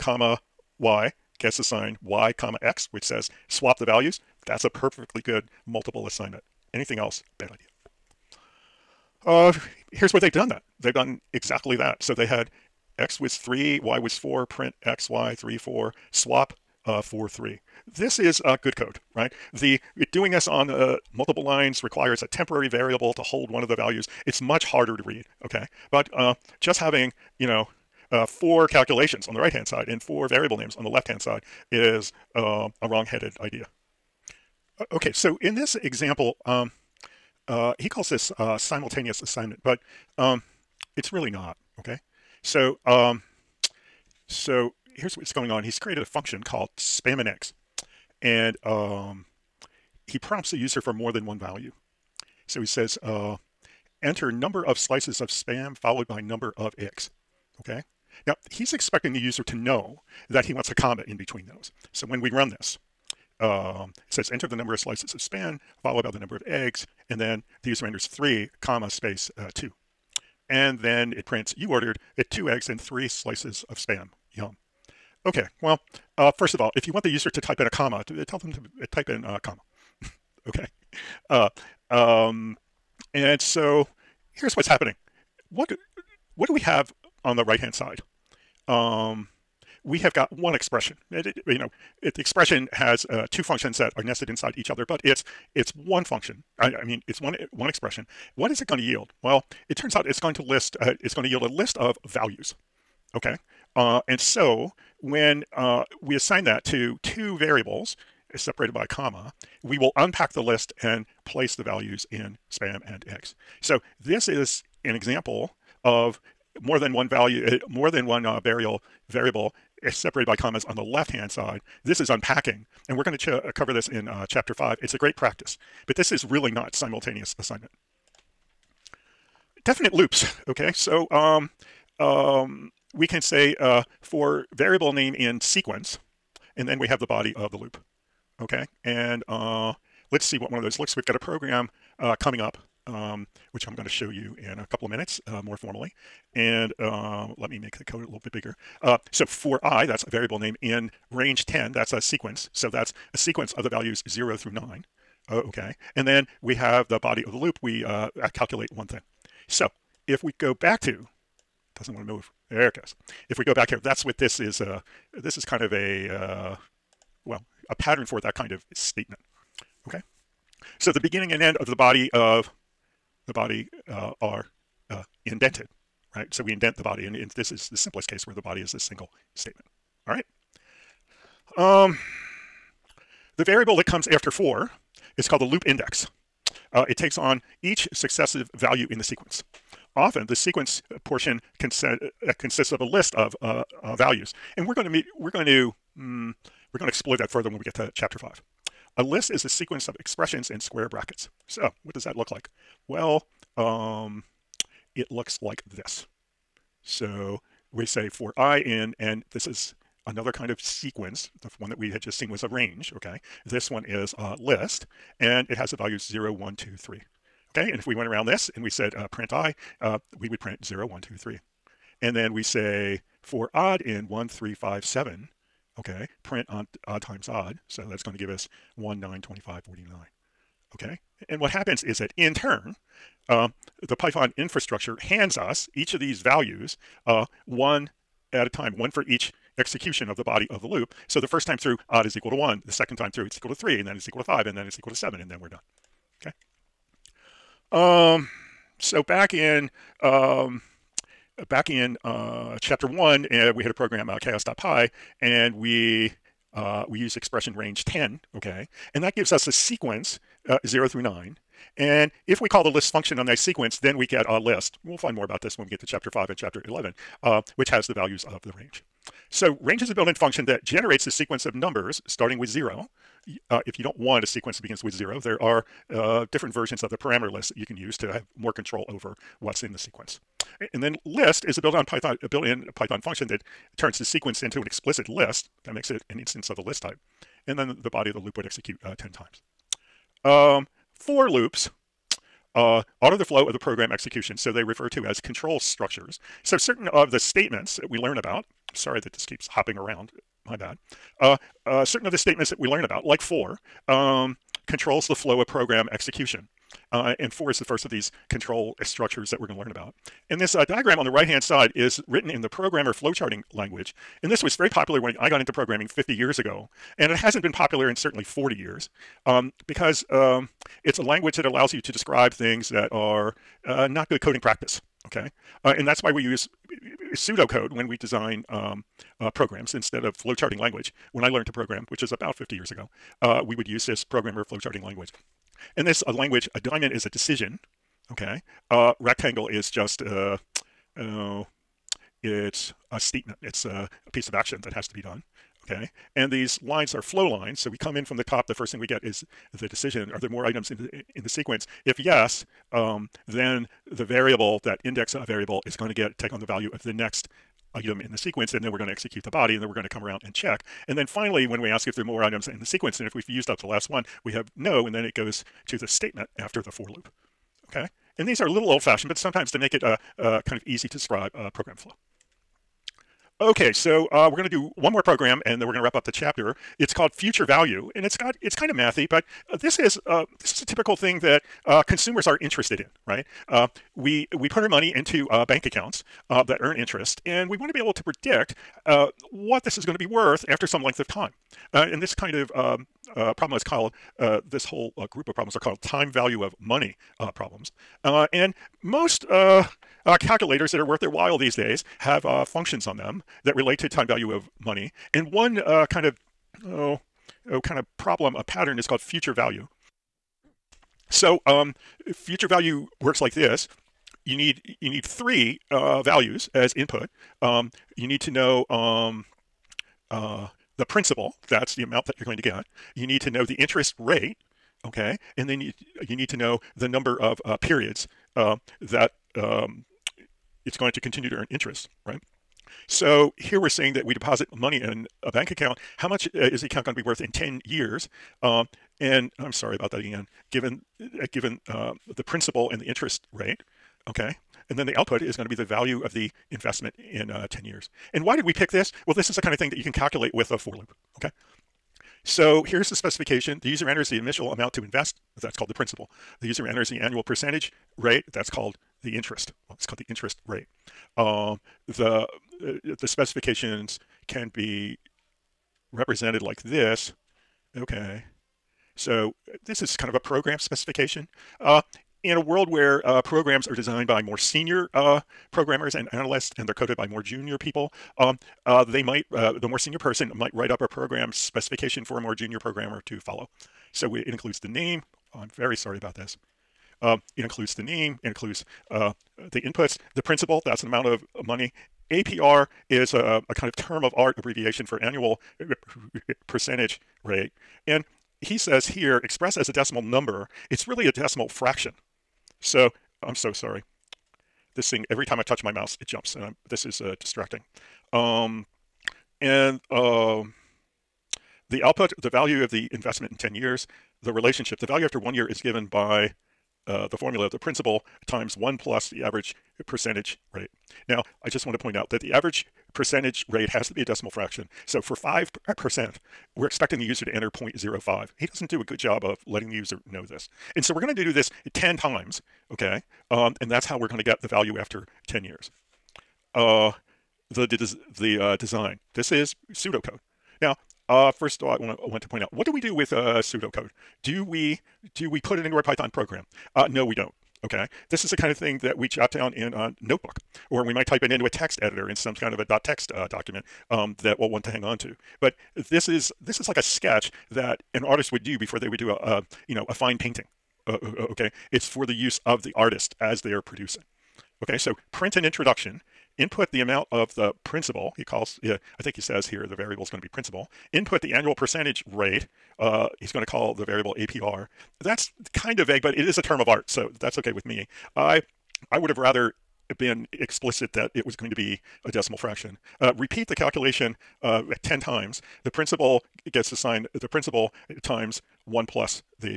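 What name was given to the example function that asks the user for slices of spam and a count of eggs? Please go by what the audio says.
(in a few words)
spamNeggs.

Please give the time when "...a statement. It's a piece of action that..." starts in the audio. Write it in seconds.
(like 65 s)
342 s.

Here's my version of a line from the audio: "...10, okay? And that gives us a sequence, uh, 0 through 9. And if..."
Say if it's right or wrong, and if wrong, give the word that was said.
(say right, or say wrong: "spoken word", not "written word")
right.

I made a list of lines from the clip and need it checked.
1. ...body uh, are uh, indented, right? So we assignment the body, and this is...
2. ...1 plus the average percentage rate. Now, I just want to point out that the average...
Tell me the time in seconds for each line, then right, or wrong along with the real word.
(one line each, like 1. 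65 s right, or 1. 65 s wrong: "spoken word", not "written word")
1. 173 s wrong: "indent", not "assignment"
2. 518 s right.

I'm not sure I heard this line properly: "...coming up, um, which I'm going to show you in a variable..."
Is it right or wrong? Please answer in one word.
wrong.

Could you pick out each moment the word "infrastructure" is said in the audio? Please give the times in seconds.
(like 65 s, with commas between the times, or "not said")
234 s.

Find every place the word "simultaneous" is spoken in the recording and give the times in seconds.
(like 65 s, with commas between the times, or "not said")
38 s, 126 s.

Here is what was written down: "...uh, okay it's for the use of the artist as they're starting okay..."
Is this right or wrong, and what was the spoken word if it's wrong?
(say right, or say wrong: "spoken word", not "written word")
wrong: "producing", not "starting".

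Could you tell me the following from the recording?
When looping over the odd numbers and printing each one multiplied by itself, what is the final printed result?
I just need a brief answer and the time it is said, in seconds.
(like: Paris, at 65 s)
49, at 229 s.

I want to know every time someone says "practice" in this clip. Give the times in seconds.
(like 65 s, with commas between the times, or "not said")
125 s, 324 s.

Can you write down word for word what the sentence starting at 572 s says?
Uh, he's going to call the variable APR.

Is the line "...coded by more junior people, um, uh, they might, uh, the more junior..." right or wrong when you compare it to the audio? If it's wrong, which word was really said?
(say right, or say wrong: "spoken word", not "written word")
wrong: "senior", not "junior".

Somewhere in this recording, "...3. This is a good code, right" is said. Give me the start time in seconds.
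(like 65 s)
17 s.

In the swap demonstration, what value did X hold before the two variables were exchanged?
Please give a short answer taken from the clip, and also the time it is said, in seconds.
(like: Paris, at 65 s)
3, at 12 s.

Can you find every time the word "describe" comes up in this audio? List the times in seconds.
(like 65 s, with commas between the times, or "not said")
321 s, 370 s.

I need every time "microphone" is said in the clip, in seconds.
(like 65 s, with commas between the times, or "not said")
not said.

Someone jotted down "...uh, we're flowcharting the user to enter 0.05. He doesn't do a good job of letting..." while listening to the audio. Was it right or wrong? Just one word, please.
wrong.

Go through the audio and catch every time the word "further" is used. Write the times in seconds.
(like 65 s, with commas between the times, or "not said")
197 s.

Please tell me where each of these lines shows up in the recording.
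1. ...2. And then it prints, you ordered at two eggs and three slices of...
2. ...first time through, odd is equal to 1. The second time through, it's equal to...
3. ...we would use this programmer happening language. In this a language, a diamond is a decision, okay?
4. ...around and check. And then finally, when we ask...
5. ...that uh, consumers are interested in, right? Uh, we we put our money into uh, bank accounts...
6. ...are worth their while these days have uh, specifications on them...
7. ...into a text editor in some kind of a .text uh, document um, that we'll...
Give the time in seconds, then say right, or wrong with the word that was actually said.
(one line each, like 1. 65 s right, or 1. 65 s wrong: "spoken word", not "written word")
1. 69 s right
2. 241 s right
3. 333 s wrong: "flowcharting", not "happening"
4. 360 s right
5. 381 s right
6. 400 s wrong: "functions", not "specifications"
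7. 551 s right.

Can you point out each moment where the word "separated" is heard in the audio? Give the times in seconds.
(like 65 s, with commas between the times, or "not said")
108 s, 119 s.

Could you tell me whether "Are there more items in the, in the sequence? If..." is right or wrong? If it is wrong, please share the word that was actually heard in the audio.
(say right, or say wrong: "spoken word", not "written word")
right.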